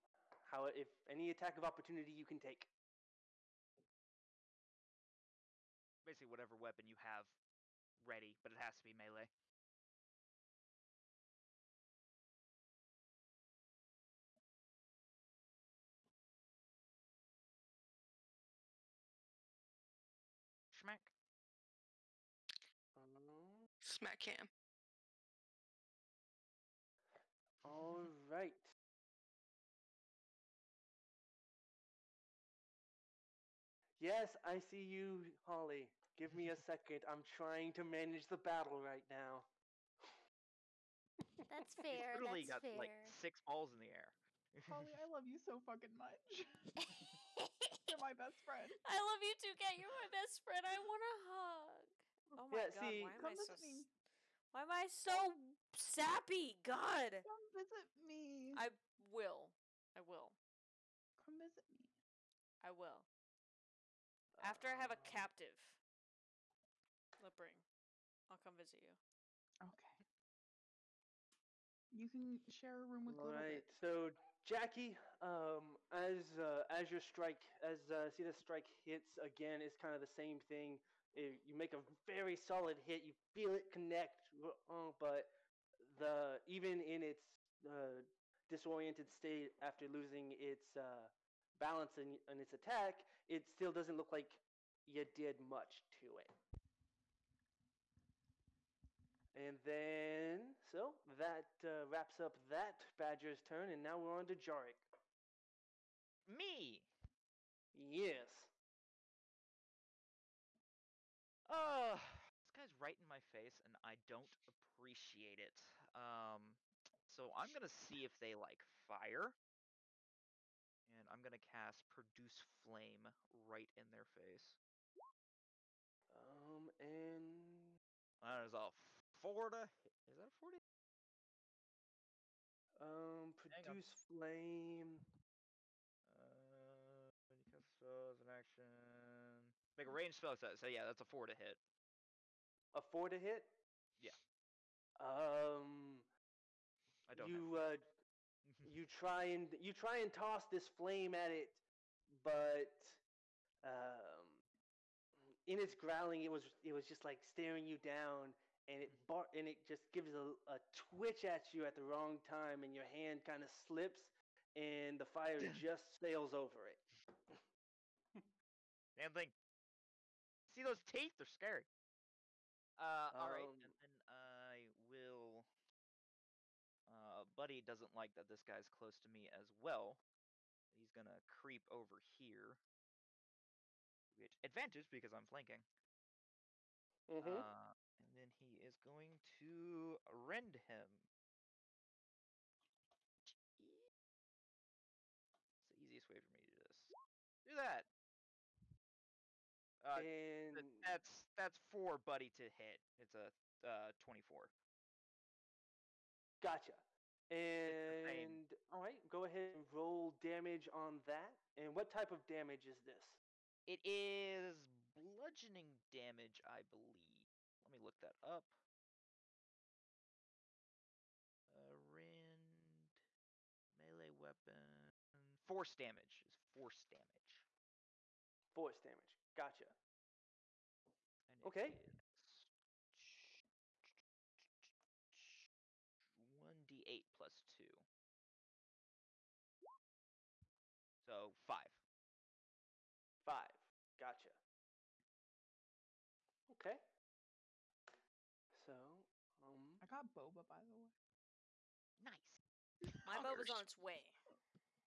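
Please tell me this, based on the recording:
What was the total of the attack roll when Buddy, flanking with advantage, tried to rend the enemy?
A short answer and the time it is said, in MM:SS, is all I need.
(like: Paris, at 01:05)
24, at 03:23.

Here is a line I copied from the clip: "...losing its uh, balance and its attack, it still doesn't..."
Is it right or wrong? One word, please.
right.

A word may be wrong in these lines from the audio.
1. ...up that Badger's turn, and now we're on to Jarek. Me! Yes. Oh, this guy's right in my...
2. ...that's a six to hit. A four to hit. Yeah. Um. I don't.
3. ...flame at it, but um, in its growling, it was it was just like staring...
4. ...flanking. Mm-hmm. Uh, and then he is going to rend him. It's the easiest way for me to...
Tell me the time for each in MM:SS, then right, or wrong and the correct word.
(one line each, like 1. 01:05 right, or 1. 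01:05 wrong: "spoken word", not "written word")
1. 01:42 right
2. 02:20 wrong: "four", not "six"
3. 02:30 right
4. 03:05 right.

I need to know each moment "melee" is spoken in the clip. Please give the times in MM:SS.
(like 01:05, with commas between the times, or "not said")
00:08, 03:43.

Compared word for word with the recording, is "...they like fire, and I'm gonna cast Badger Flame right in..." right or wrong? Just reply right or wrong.
wrong.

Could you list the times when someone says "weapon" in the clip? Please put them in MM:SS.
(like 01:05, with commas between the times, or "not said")
00:06, 03:44.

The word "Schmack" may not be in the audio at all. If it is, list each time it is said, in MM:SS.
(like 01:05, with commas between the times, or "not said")
00:20.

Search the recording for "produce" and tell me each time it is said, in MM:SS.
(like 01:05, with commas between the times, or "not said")
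02:01, 02:13.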